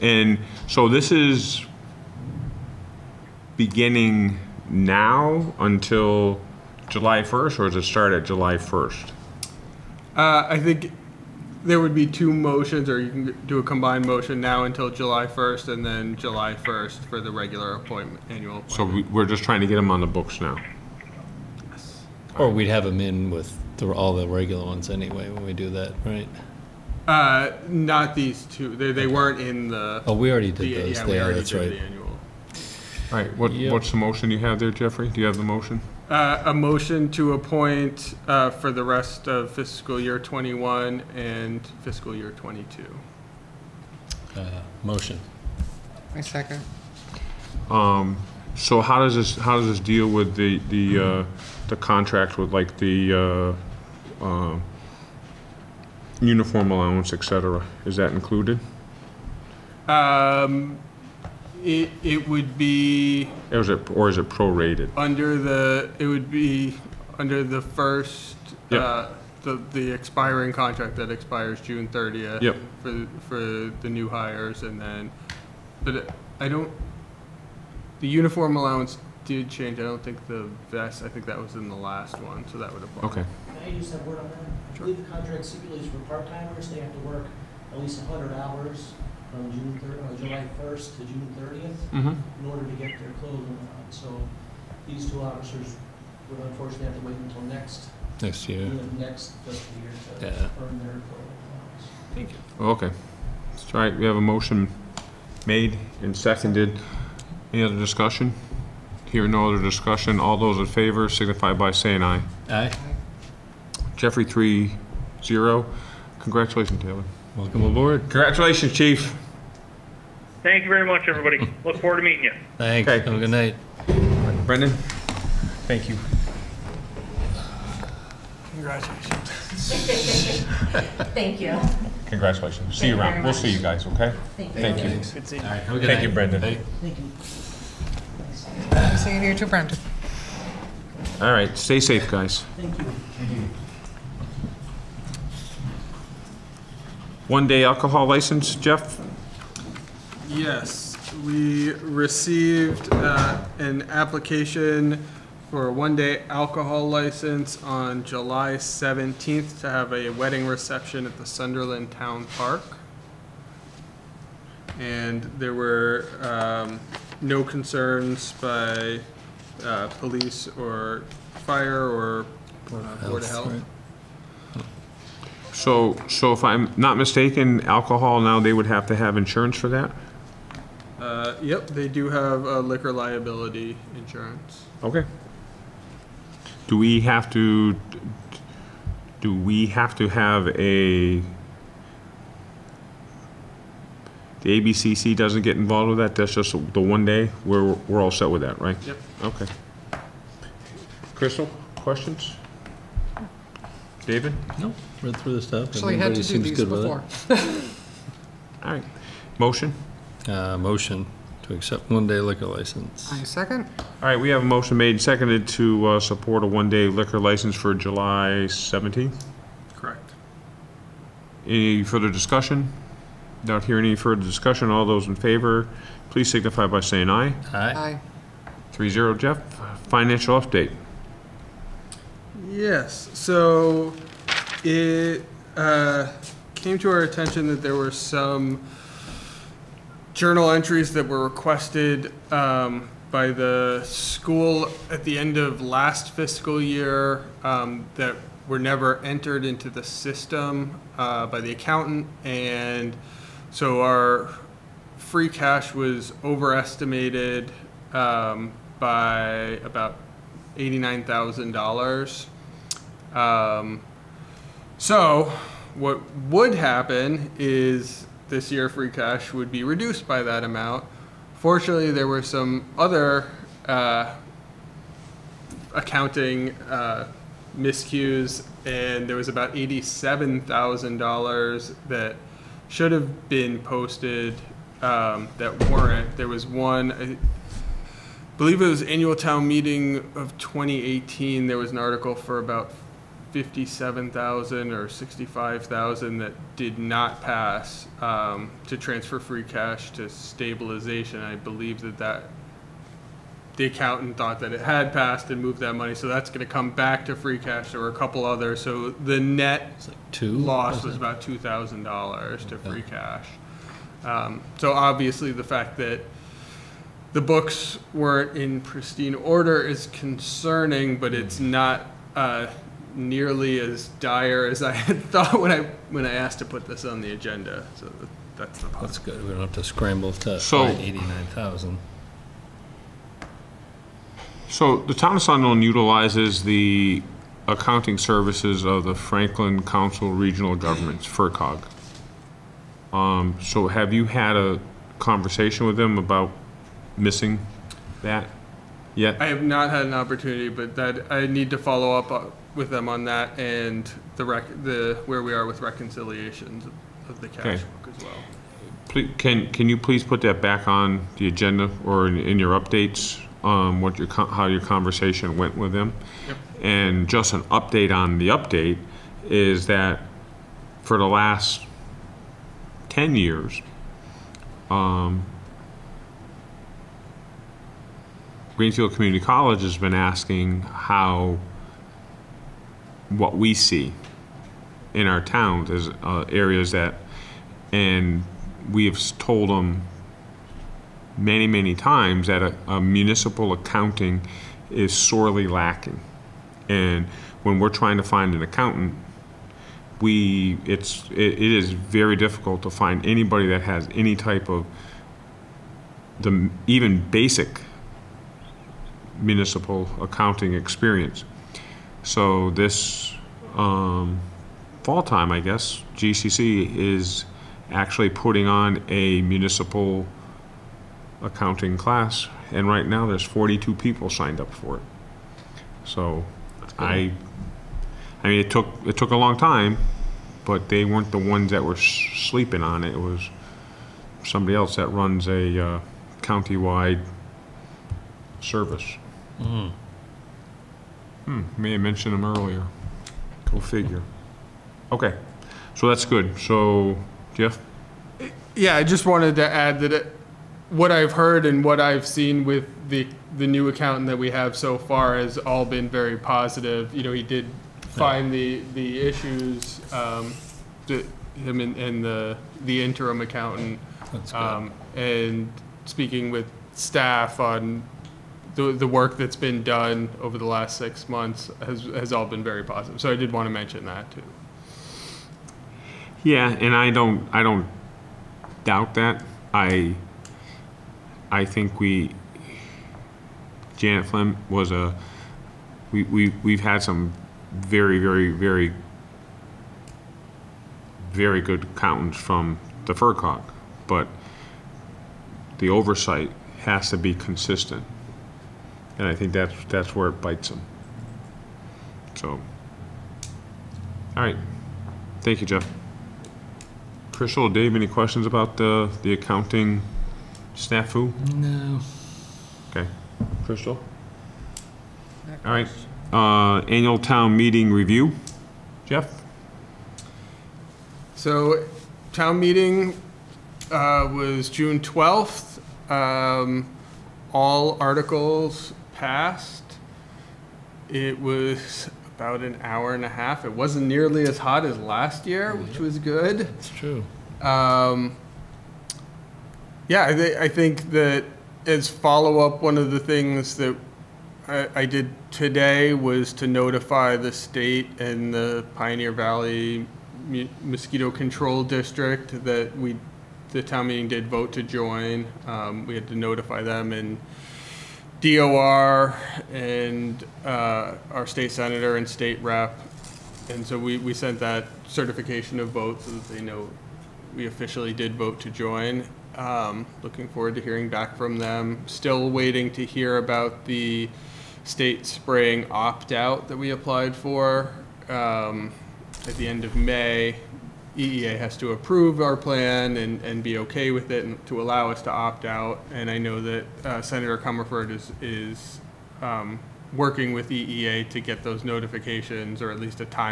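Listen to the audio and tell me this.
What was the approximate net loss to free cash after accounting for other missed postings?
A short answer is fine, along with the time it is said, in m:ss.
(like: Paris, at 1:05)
$2,000, at 5:11.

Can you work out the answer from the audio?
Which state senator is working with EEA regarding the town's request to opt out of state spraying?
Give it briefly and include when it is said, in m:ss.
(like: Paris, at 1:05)
Senator Comerford, at 9:47.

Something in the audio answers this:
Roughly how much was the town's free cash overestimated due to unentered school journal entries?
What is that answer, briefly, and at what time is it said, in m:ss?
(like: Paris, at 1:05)
$89,000, at 4:20.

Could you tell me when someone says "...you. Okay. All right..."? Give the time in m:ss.
1:42.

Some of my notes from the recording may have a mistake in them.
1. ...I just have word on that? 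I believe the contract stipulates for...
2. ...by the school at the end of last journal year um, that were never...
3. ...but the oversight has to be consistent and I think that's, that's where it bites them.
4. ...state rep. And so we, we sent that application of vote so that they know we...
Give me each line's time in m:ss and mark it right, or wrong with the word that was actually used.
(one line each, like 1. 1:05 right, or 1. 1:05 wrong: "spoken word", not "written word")
1. 1:23 right
2. 4:03 wrong: "fiscal", not "journal"
3. 8:13 right
4. 9:22 wrong: "certification", not "application".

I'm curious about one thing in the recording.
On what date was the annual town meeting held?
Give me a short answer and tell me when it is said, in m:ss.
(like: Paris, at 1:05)
June 12th, at 8:44.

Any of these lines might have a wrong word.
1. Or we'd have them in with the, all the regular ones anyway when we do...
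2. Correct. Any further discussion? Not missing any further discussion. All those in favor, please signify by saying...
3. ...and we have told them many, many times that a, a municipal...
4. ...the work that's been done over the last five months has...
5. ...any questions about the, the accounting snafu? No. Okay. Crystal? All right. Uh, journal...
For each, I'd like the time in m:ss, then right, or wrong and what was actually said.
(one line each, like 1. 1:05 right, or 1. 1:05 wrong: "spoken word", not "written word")
1. 0:22 right
2. 3:39 wrong: "hearing", not "missing"
3. 6:27 right
4. 7:48 wrong: "six", not "five"
5. 8:27 wrong: "annual", not "journal".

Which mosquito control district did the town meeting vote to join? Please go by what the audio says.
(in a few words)
Pioneer Valley.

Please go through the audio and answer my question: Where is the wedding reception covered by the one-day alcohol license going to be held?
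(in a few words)
Sunderland Town Park.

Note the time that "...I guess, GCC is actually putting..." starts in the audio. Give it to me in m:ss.
6:55.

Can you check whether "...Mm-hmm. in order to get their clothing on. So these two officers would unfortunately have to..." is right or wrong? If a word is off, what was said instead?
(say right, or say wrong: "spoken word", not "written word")
right.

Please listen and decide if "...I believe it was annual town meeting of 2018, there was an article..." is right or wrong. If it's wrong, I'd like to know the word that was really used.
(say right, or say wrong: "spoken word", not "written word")
right.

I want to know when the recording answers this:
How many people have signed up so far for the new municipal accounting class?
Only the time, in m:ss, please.
7:03.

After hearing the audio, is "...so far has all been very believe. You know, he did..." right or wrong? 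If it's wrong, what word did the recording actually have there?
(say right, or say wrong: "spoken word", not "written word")
wrong: "positive", not "believe".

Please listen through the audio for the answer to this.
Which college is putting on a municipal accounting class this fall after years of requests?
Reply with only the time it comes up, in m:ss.
6:18.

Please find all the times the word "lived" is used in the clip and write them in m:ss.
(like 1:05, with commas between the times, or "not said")
not said.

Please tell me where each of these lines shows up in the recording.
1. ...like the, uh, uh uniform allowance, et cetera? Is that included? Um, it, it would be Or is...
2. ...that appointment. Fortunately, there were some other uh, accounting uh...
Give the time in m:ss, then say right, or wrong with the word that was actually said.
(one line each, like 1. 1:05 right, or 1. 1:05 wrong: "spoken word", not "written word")
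1. 0:52 right
2. 4:30 wrong: "amount", not "appointment".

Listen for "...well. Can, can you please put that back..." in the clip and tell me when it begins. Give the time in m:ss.
5:58.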